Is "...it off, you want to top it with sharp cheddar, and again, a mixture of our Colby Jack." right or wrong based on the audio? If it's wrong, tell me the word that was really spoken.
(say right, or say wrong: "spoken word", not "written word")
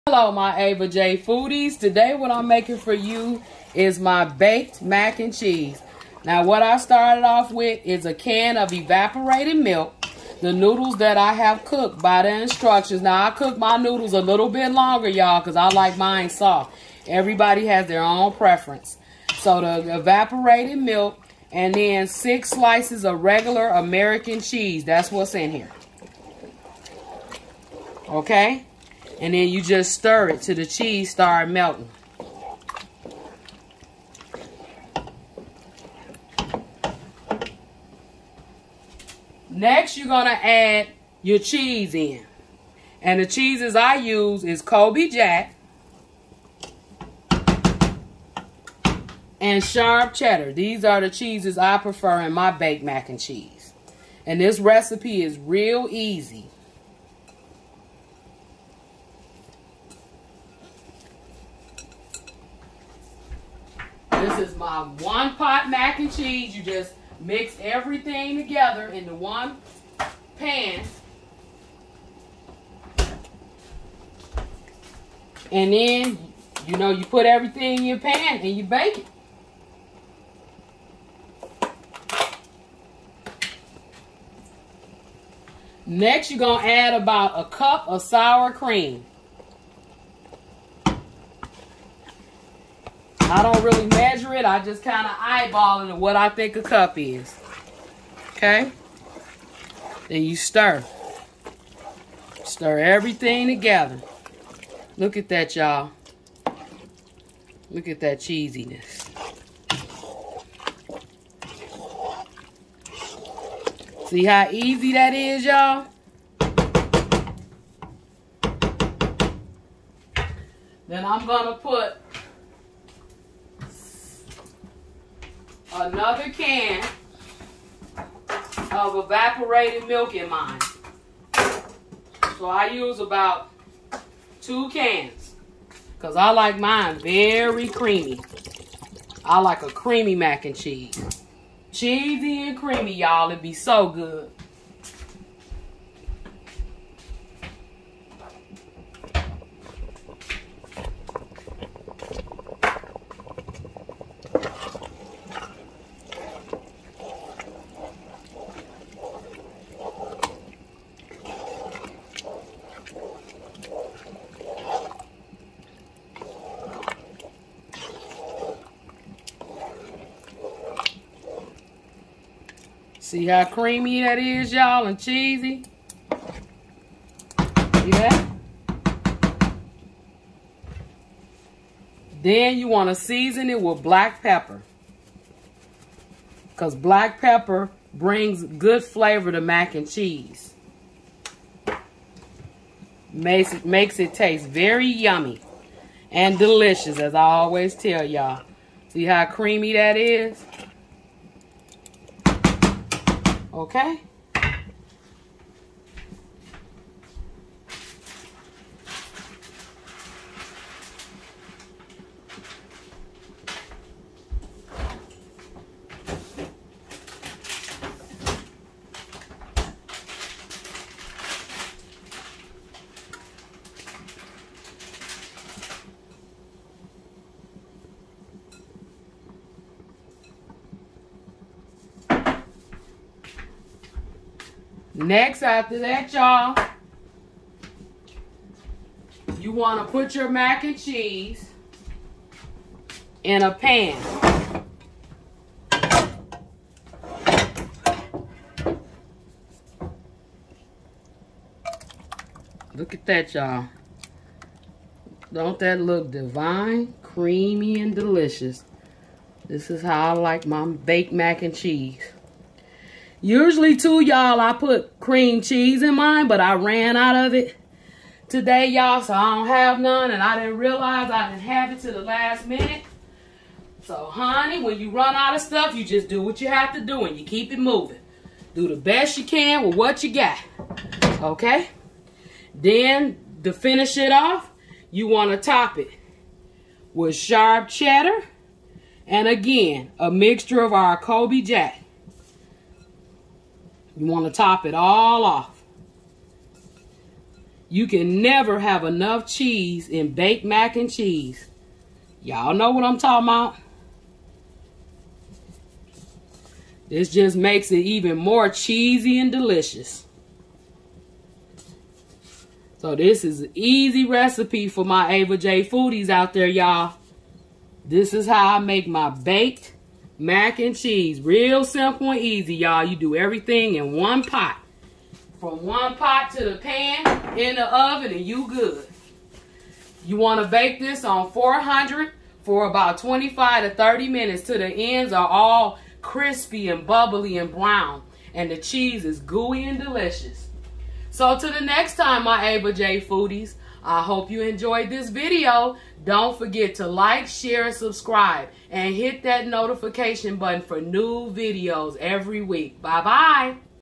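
right.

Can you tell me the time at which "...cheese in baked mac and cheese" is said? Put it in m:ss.
4:59.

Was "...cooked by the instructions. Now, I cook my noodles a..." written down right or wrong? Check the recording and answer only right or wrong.
right.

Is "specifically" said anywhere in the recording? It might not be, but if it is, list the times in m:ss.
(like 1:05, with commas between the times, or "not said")
not said.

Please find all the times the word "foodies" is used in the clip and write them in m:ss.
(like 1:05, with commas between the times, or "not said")
0:01, 5:15, 5:43.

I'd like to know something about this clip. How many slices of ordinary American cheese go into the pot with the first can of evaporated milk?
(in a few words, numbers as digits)
6.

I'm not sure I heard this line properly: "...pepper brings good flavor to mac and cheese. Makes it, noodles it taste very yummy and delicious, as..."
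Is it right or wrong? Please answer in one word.
wrong.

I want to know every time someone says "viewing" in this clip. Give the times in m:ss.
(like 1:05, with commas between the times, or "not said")
not said.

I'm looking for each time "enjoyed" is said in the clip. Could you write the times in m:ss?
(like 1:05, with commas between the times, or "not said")
5:44.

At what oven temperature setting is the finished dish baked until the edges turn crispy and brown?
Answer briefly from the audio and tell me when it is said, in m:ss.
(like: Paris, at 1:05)
400, at 5:31.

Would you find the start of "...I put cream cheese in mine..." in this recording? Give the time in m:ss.
4:24.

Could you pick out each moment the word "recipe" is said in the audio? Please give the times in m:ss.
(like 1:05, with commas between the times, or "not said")
0:54, 5:14.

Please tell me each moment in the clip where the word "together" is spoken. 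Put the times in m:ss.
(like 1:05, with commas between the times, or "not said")
1:08, 1:43.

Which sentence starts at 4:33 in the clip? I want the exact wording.
So, honey, when you run out of stuff, you just do what you have to do, and you keep it moving.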